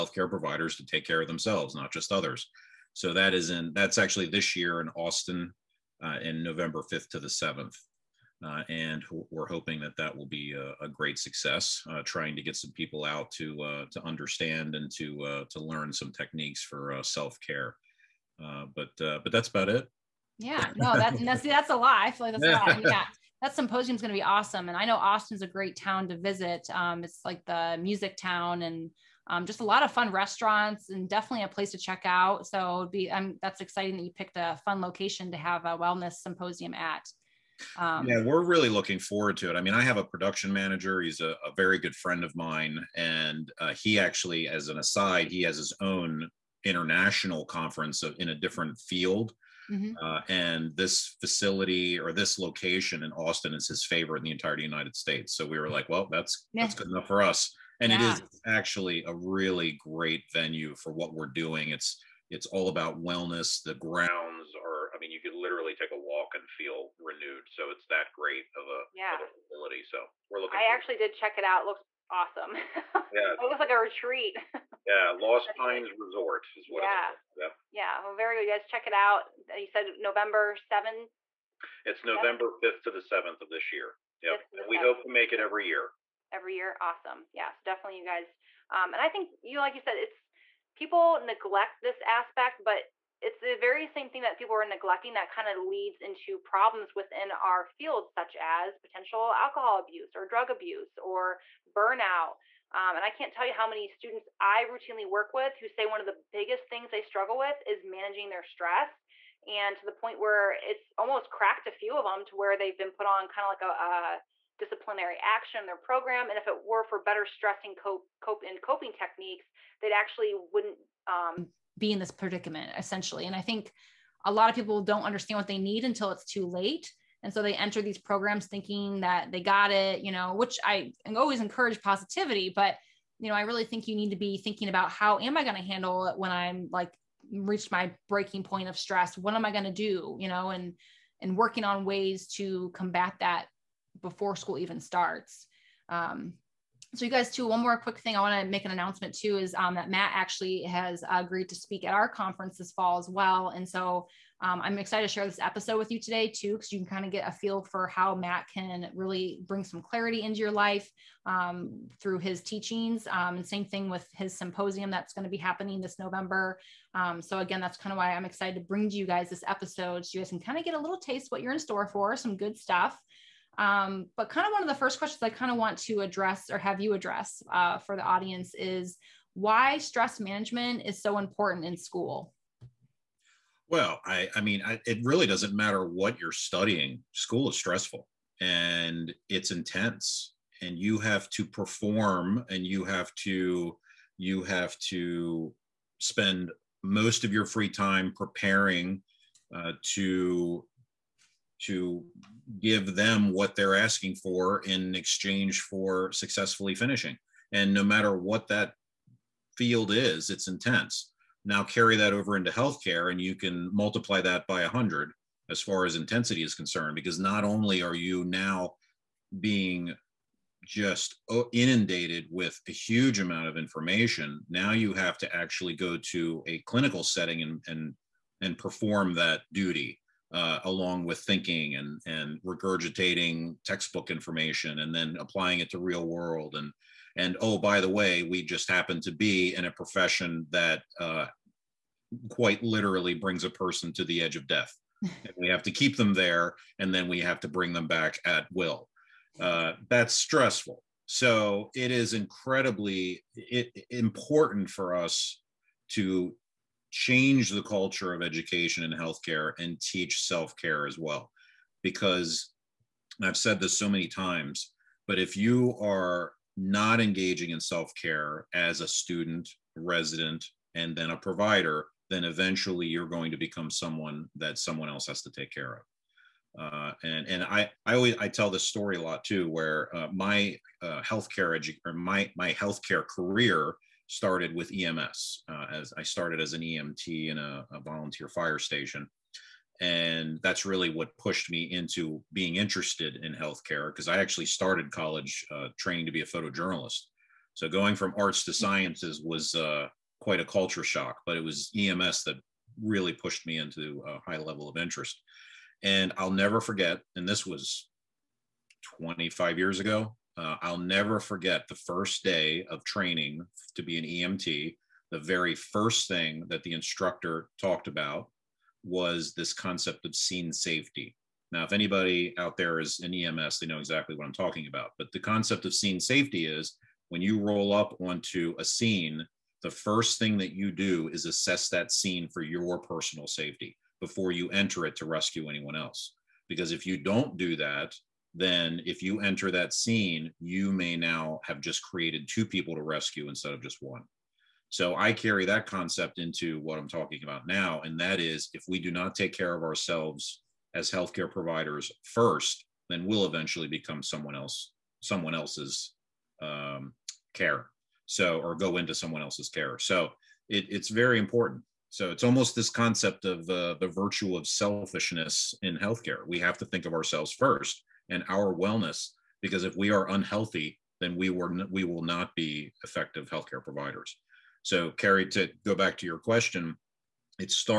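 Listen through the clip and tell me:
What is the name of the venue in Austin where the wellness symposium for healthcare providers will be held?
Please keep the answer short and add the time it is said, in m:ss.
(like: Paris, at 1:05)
Lost Pines Resort, at 1:15.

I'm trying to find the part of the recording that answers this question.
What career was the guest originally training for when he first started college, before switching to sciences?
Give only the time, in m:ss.
4:56.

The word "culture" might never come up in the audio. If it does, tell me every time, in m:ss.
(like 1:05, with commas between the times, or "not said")
4:17, 5:00.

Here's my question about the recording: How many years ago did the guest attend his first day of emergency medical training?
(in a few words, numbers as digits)
25.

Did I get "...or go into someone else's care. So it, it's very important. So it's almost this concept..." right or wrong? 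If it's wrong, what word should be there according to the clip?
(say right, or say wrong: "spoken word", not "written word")
right.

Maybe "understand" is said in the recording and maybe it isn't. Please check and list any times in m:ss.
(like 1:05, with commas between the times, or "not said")
0:14, 2:05.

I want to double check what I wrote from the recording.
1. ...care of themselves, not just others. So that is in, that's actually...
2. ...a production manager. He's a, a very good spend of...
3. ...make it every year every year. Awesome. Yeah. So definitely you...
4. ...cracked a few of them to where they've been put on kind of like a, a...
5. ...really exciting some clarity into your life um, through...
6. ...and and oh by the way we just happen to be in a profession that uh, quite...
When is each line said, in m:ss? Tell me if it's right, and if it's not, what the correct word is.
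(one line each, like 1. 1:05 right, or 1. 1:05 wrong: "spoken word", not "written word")
1. 0:01 right
2. 0:39 wrong: "friend", not "spend"
3. 1:25 right
4. 1:51 right
5. 2:38 wrong: "bring", not "exciting"
6. 3:56 right.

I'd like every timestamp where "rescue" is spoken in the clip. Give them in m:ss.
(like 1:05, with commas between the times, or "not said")
5:35, 5:42.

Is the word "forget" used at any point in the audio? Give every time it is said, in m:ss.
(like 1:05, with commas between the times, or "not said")
5:06, 5:11.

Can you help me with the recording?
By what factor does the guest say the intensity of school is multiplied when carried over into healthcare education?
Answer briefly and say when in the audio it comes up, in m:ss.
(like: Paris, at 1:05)
100, at 3:34.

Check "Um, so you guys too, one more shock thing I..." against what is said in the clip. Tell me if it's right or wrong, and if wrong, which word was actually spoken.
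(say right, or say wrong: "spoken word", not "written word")
wrong: "quick", not "shock".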